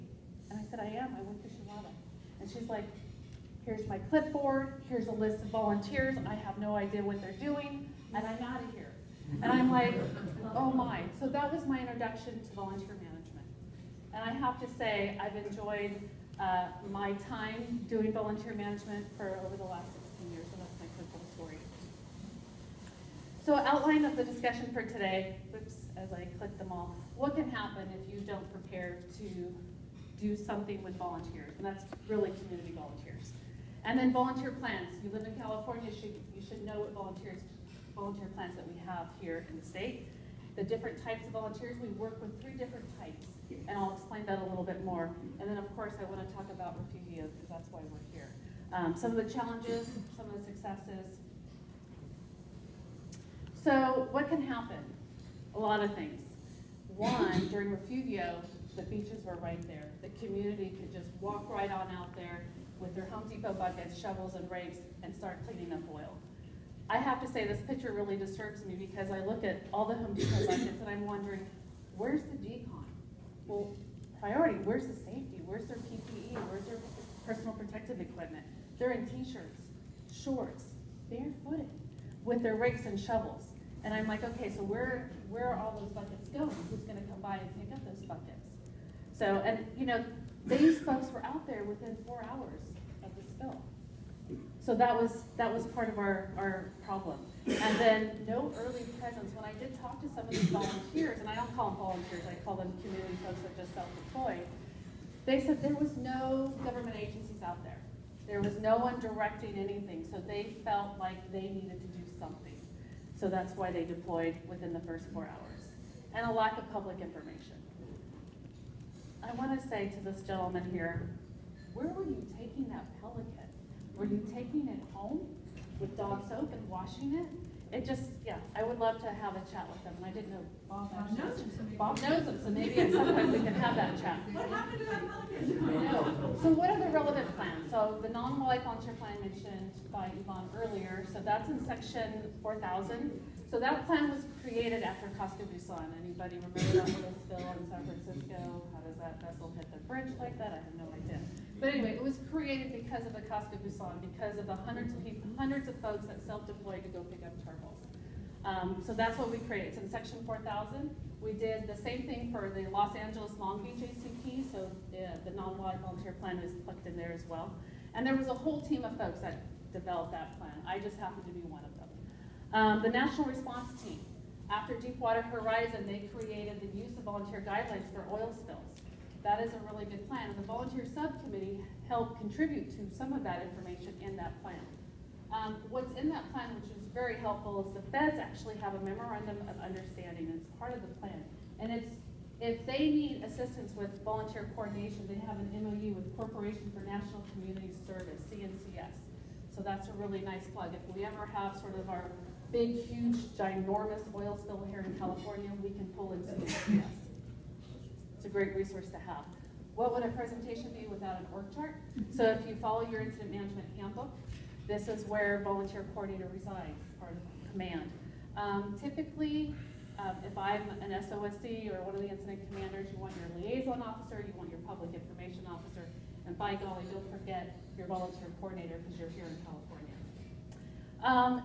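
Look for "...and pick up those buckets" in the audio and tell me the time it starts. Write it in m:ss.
1:27.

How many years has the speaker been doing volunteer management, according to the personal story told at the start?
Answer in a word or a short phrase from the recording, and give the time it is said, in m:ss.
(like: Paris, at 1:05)
16 years, at 0:20.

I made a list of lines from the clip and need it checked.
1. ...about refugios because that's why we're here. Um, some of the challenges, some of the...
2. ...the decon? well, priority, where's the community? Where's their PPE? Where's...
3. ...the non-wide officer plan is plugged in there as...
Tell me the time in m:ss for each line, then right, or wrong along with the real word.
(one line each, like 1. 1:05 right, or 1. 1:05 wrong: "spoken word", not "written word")
1. 0:46 right
2. 1:12 wrong: "safety", not "community"
3. 2:45 wrong: "volunteer", not "officer".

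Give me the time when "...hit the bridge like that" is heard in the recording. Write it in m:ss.
2:29.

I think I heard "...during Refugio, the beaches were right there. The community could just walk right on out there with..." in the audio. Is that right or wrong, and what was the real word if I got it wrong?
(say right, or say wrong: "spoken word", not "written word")
right.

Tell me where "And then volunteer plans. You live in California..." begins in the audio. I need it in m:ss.
0:33.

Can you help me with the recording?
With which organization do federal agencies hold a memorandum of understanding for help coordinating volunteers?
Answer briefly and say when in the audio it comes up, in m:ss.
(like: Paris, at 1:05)
Corporation for National Community Service, at 3:16.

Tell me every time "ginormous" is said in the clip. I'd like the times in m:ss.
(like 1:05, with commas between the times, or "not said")
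3:23.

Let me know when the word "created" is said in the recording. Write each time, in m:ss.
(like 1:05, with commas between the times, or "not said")
2:24, 2:32, 2:39, 2:56.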